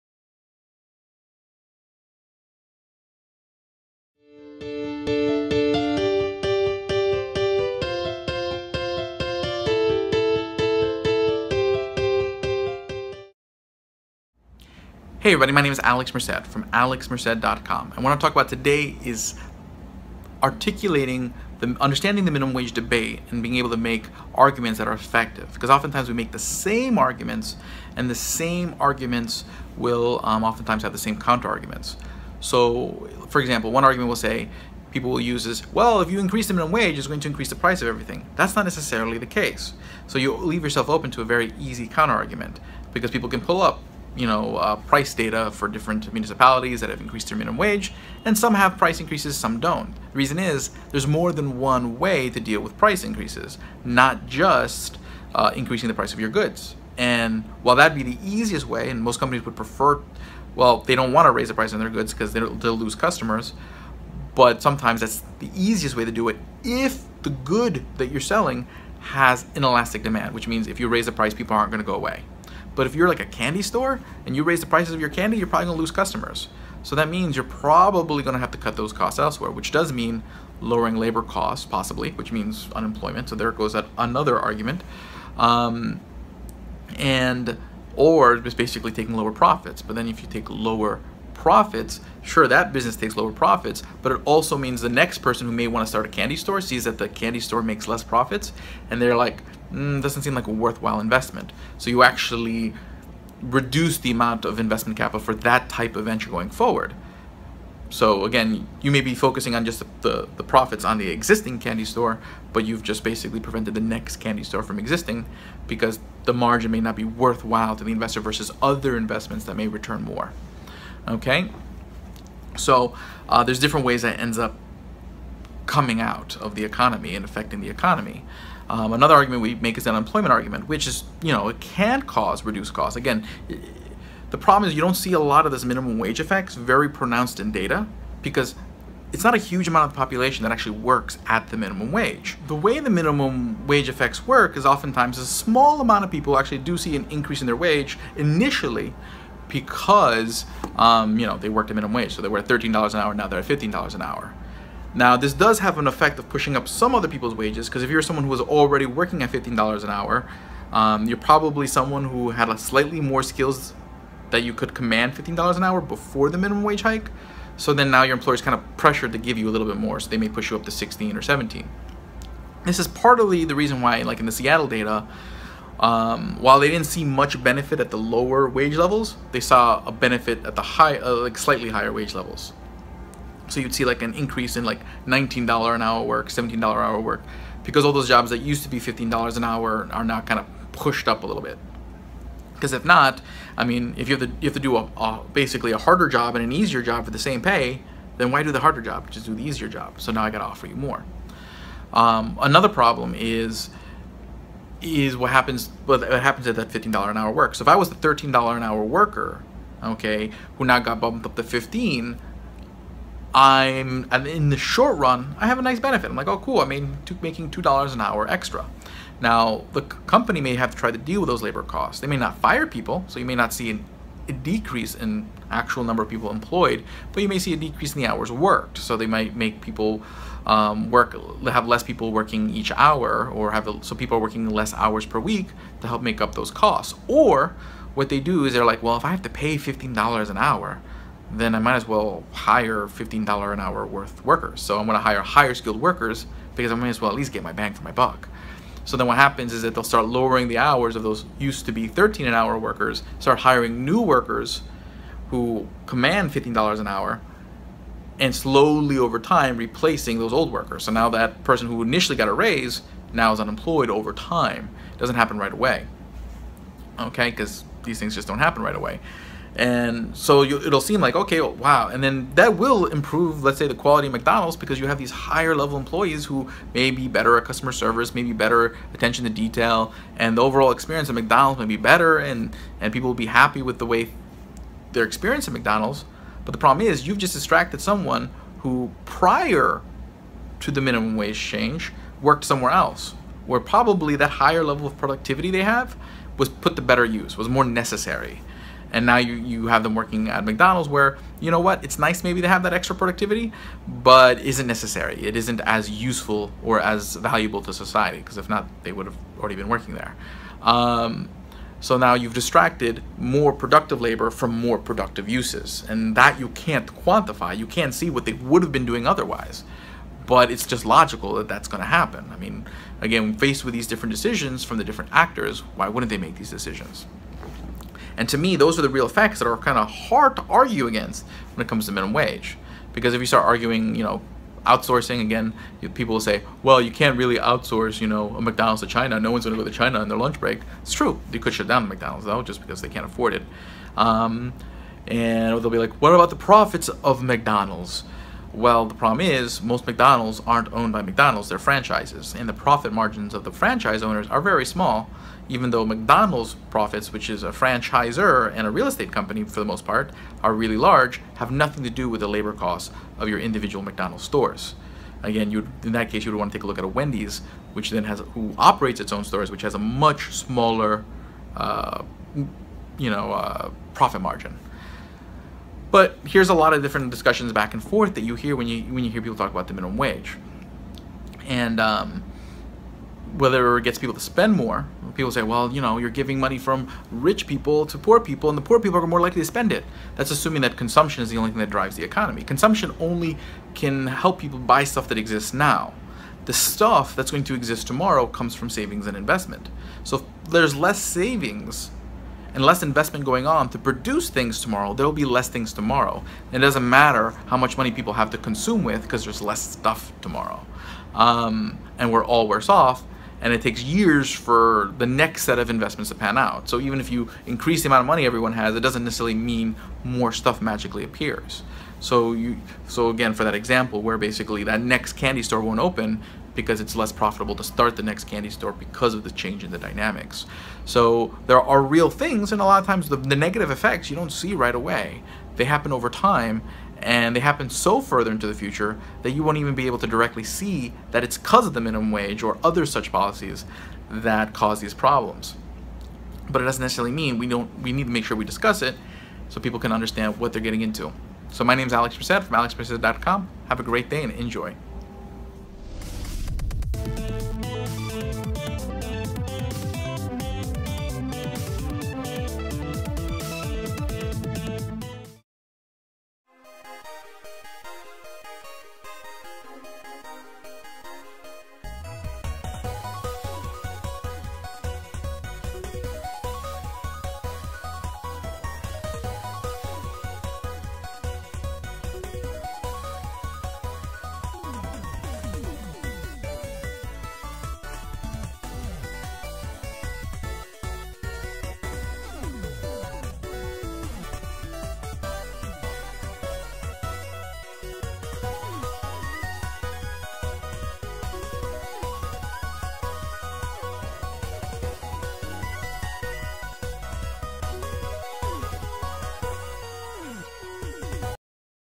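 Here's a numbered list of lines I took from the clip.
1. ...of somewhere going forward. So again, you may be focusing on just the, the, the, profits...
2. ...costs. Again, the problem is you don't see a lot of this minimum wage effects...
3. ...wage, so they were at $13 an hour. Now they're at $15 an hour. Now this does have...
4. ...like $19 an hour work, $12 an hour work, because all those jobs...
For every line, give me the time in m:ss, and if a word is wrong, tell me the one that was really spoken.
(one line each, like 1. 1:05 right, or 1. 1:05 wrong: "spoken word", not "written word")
1. 1:45 wrong: "venture", not "somewhere"
2. 2:12 right
3. 2:31 right
4. 3:04 wrong: "17", not "12".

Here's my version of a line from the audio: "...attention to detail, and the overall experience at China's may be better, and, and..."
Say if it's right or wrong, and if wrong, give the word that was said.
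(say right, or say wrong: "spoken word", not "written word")
wrong: "McDonald", not "China".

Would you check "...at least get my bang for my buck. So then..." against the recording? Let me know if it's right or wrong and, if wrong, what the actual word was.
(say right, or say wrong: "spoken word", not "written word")
right.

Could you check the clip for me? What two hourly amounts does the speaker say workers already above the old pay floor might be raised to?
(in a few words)
16 or 17.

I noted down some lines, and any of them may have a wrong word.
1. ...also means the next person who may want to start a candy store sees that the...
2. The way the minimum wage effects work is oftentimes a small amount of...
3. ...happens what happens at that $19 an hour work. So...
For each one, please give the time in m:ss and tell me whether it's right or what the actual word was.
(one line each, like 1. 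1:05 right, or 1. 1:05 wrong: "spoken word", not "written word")
1. 1:34 right
2. 2:22 right
3. 3:25 wrong: "15", not "19".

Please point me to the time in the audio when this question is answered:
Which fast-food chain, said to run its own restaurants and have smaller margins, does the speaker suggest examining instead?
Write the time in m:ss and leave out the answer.
6:06.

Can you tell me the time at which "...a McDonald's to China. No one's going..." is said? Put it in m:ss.
5:38.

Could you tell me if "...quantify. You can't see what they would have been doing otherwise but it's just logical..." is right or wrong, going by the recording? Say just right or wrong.
right.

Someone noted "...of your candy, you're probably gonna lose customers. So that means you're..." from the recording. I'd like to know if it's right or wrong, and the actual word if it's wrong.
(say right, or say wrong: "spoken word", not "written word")
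right.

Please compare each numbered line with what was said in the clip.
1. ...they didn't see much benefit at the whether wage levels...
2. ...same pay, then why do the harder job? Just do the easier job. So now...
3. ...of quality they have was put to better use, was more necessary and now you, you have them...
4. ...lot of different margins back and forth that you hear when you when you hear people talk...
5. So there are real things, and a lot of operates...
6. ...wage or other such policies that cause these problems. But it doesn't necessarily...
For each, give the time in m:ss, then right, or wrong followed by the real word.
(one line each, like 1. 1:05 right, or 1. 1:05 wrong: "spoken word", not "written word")
1. 2:56 wrong: "lower", not "whether"
2. 3:17 right
3. 4:54 wrong: "productivity", not "quality"
4. 6:16 wrong: "discussions", not "margins"
5. 7:10 wrong: "times", not "operates"
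6. 7:22 right.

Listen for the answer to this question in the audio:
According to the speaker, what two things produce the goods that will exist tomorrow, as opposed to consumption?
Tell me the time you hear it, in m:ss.
6:38.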